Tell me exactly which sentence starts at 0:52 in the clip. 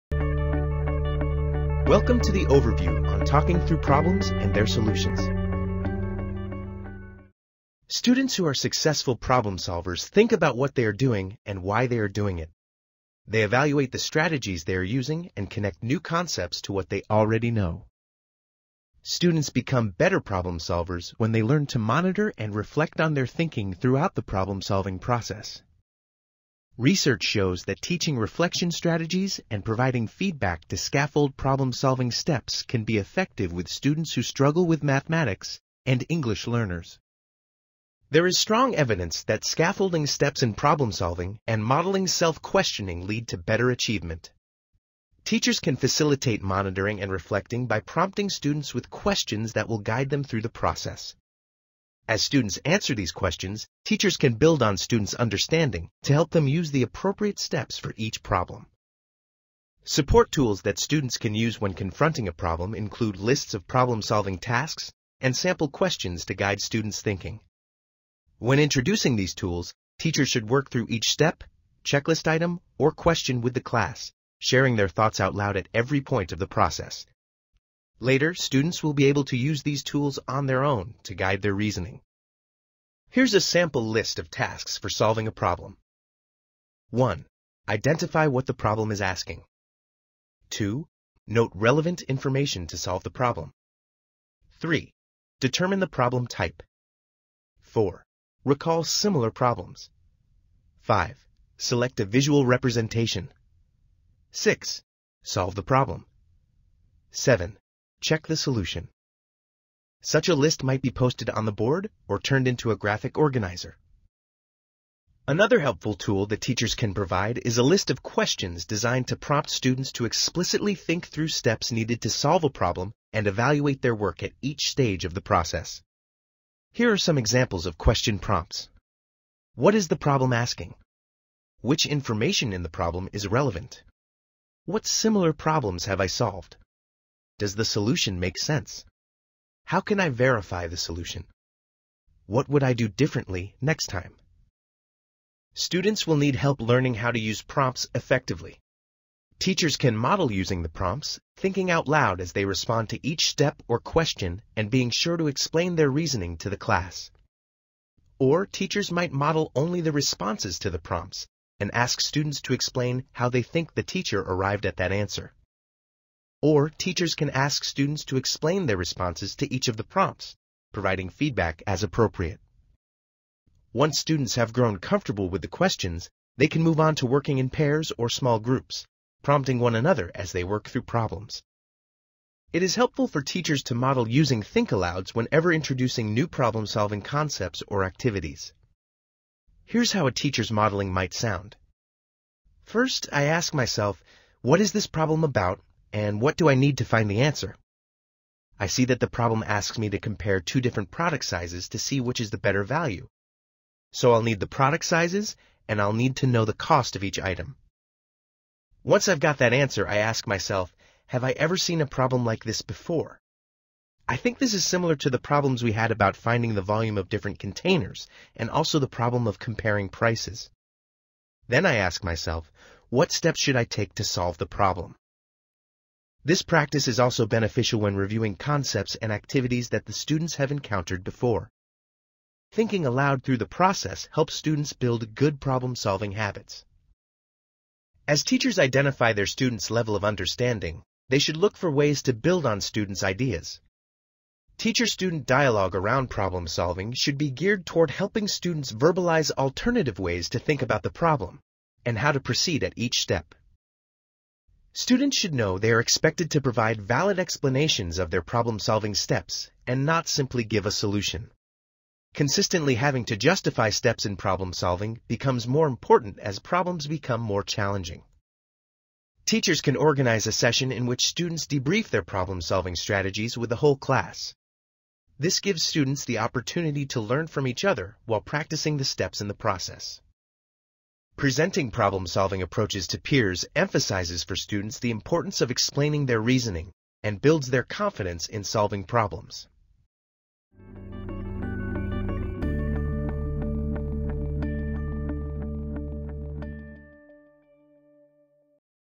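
As students answer these questions, teachers can build on students' understanding to help them use the appropriate steps for each problem.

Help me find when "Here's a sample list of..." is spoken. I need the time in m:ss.
1:23.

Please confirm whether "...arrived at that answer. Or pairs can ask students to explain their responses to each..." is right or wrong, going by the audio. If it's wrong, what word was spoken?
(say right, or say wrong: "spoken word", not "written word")
wrong: "teachers", not "pairs".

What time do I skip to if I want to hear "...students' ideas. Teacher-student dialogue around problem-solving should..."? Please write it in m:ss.
4:02.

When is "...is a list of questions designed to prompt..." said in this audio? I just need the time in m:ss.
1:57.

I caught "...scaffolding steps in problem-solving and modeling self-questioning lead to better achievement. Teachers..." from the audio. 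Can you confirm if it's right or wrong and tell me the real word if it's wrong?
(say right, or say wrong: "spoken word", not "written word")
right.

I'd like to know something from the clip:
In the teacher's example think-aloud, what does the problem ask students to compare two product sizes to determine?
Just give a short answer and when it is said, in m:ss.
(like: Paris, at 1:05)
The better value, at 3:22.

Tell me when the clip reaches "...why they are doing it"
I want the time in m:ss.
0:11.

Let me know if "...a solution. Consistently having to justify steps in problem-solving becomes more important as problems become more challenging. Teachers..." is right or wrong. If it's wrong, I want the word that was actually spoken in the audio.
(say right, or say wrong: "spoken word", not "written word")
right.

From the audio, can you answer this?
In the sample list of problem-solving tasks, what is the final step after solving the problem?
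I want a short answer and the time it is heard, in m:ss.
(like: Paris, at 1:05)
Check the solution, at 1:48.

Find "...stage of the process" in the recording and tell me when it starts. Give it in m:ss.
2:04.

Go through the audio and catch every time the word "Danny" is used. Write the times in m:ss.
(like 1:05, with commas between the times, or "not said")
not said.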